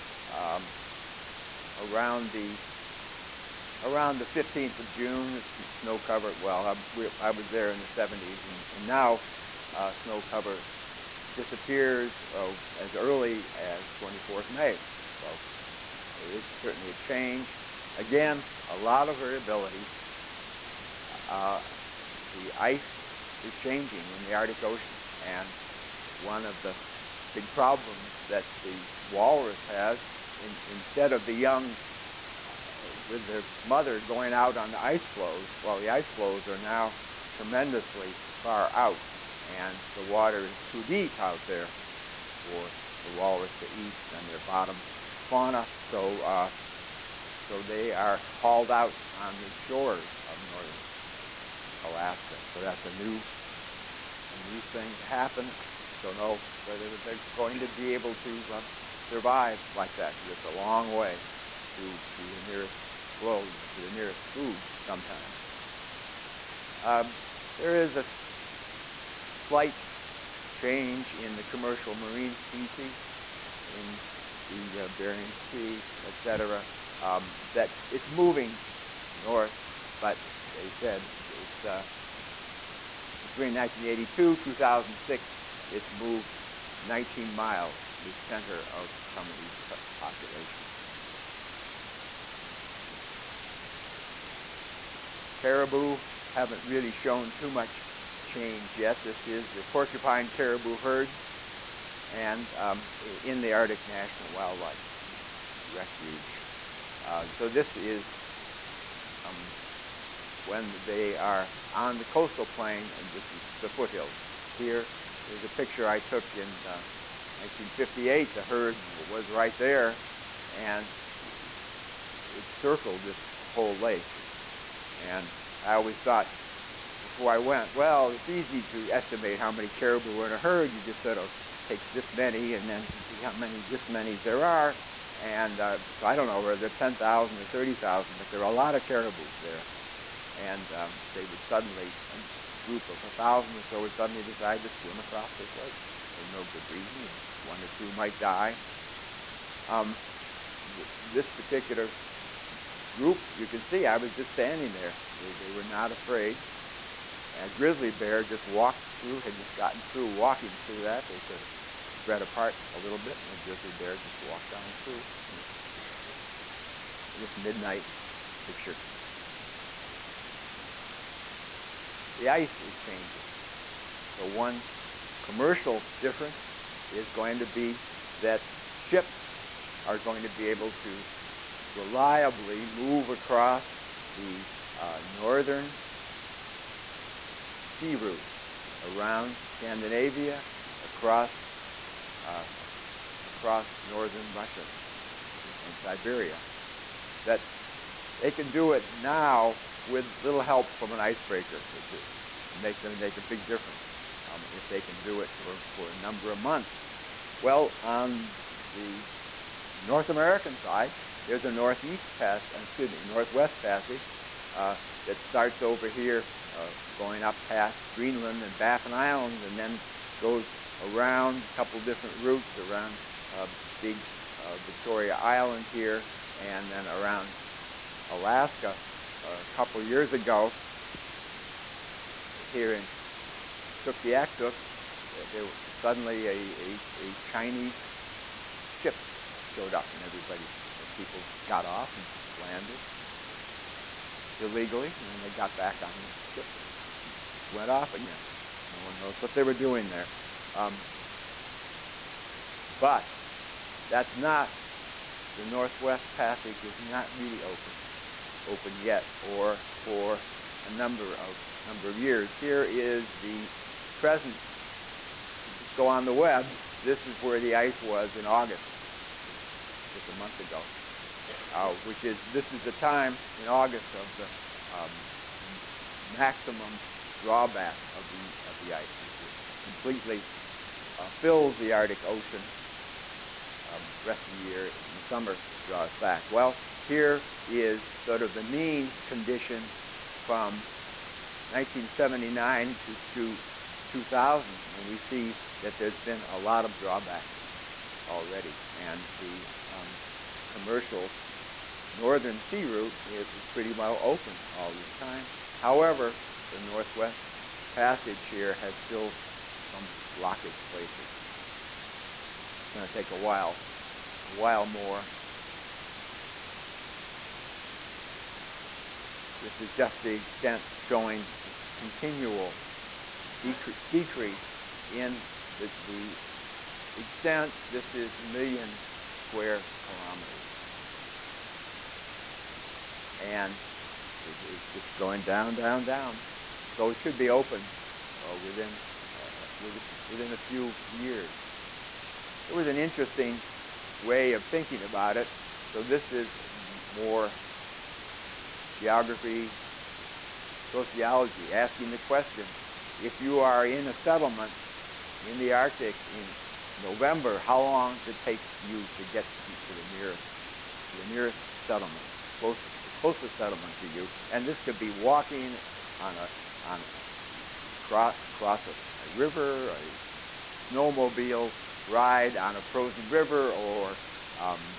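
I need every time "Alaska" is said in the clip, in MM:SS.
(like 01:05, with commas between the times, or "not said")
00:51, 03:48.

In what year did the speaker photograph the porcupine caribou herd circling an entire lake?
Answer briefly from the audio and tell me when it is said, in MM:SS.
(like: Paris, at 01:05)
1958, at 01:57.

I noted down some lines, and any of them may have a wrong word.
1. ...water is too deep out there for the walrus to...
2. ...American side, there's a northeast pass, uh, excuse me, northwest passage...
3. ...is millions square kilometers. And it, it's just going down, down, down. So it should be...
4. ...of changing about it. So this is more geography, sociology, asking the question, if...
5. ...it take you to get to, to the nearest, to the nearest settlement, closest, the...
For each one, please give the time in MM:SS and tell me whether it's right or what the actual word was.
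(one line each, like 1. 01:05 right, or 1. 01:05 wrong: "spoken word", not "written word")
1. 00:40 right
2. 03:30 right
3. 05:27 right
4. 05:44 wrong: "thinking", not "changing"
5. 05:58 right.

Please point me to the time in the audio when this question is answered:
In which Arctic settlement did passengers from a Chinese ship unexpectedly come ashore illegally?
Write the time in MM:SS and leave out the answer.
03:53.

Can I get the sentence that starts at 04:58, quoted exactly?
And the um, commercial northern sea route, it was pretty well open all this time.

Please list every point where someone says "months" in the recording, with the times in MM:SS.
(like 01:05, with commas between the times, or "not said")
03:26, 04:30.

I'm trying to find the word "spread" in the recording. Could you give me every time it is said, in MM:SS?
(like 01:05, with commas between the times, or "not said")
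02:41.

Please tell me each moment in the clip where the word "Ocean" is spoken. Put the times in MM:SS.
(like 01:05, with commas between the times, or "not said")
00:24, 04:42.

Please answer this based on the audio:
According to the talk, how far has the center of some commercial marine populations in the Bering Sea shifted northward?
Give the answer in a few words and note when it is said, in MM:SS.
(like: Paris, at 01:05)
19 miles, at 01:26.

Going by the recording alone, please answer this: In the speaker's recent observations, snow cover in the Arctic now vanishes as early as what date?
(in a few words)
24th May.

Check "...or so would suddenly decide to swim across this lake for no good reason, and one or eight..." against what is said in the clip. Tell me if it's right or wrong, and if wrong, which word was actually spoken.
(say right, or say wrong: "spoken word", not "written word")
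wrong: "two", not "eight".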